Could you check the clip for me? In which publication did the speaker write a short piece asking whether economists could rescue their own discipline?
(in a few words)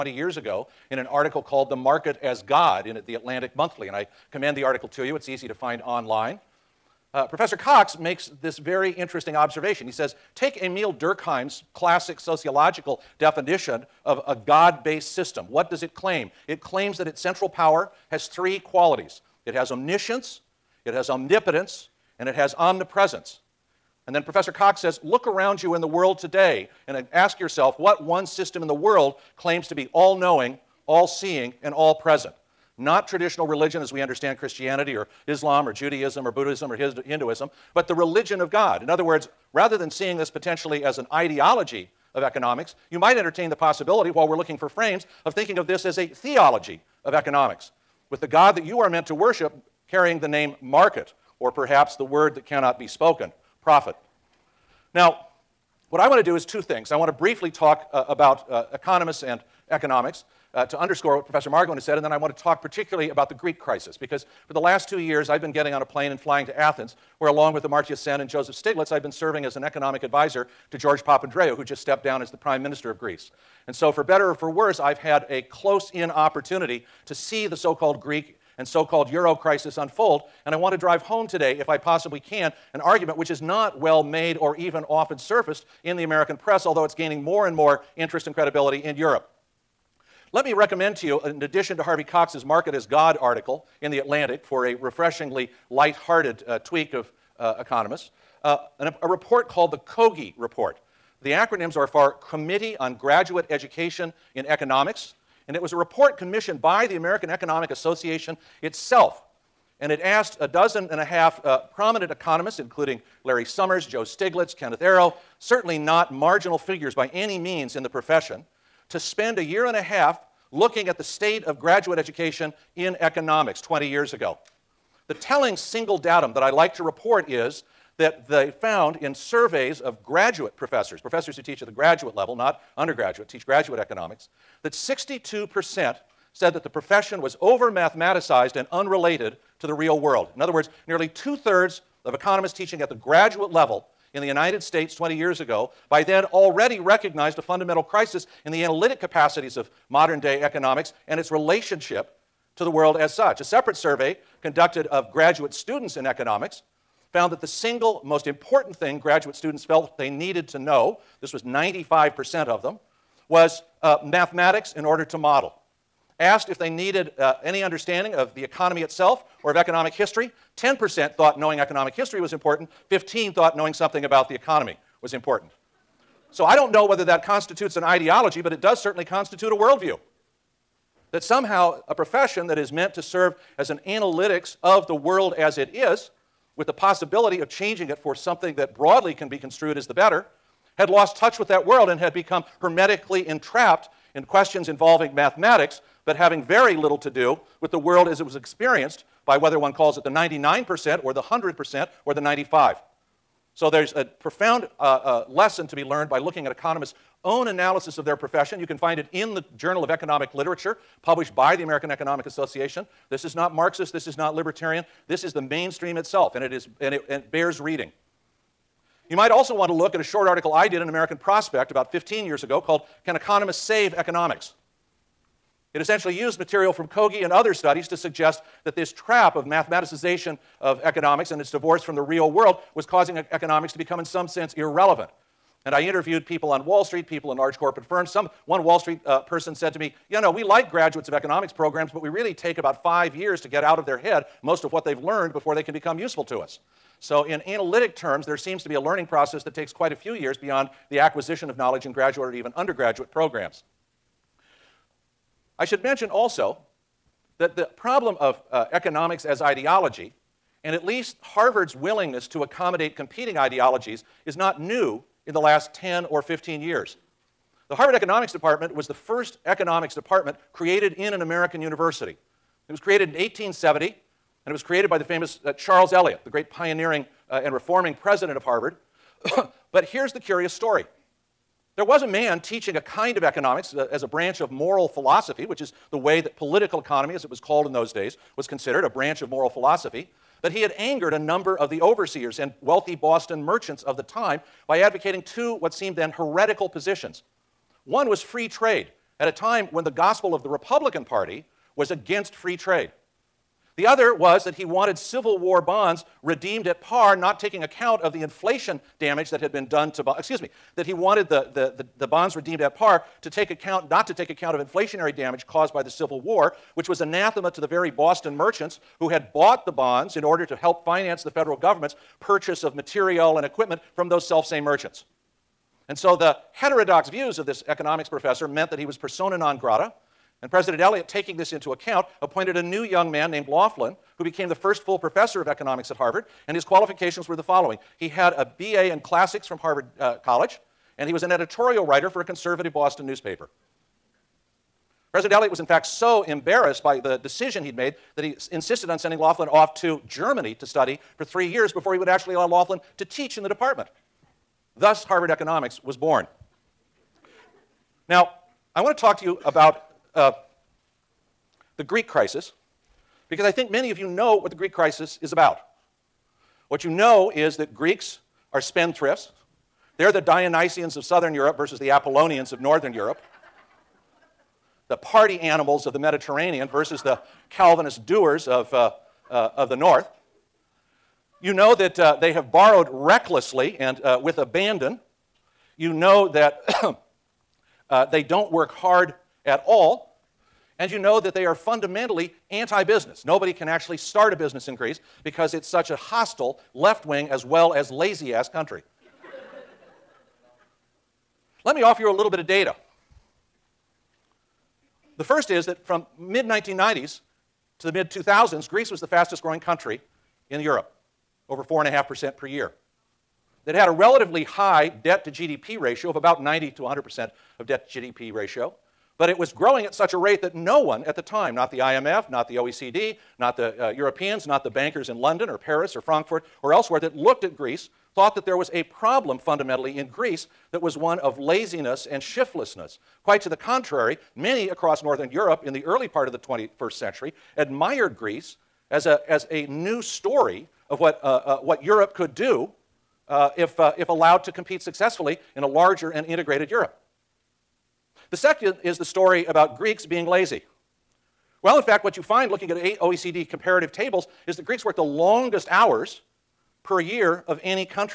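American Prospect.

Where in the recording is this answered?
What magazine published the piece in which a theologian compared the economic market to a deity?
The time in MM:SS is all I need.
00:03.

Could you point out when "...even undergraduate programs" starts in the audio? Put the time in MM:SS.
04:12.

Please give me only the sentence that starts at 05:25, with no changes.
And so the heterodox views of this economics professor meant that he was persona non grata.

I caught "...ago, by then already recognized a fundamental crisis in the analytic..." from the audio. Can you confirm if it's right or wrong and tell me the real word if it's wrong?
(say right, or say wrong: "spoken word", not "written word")
right.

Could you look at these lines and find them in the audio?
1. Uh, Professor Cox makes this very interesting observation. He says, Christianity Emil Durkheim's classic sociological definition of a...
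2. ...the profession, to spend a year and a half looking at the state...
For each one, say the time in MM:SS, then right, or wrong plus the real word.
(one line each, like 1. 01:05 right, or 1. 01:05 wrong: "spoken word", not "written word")
1. 00:07 wrong: "Take", not "Christianity"
2. 01:57 right.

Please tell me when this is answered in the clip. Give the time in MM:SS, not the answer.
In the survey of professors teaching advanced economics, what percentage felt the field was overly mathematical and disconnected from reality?
02:14.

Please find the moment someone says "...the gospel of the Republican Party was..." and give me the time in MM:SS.
04:59.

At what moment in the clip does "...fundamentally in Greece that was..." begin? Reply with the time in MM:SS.
07:09.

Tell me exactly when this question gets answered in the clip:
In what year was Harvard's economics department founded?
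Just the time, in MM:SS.
04:33.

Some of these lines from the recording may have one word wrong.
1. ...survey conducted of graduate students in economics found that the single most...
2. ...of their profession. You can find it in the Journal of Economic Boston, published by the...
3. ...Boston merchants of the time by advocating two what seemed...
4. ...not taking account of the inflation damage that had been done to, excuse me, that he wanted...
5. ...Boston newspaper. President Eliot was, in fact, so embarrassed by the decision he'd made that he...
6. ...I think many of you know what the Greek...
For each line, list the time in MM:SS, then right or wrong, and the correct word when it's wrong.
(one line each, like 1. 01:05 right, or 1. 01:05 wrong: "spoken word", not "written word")
1. 02:33 right
2. 03:27 wrong: "Literature", not "Boston"
3. 04:52 right
4. 05:07 right
5. 05:42 right
6. 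06:03 right.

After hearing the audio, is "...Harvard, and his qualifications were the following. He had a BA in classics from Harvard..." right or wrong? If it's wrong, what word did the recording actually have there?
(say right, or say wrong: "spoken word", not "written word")
right.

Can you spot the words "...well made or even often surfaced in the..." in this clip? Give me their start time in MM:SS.
01:23.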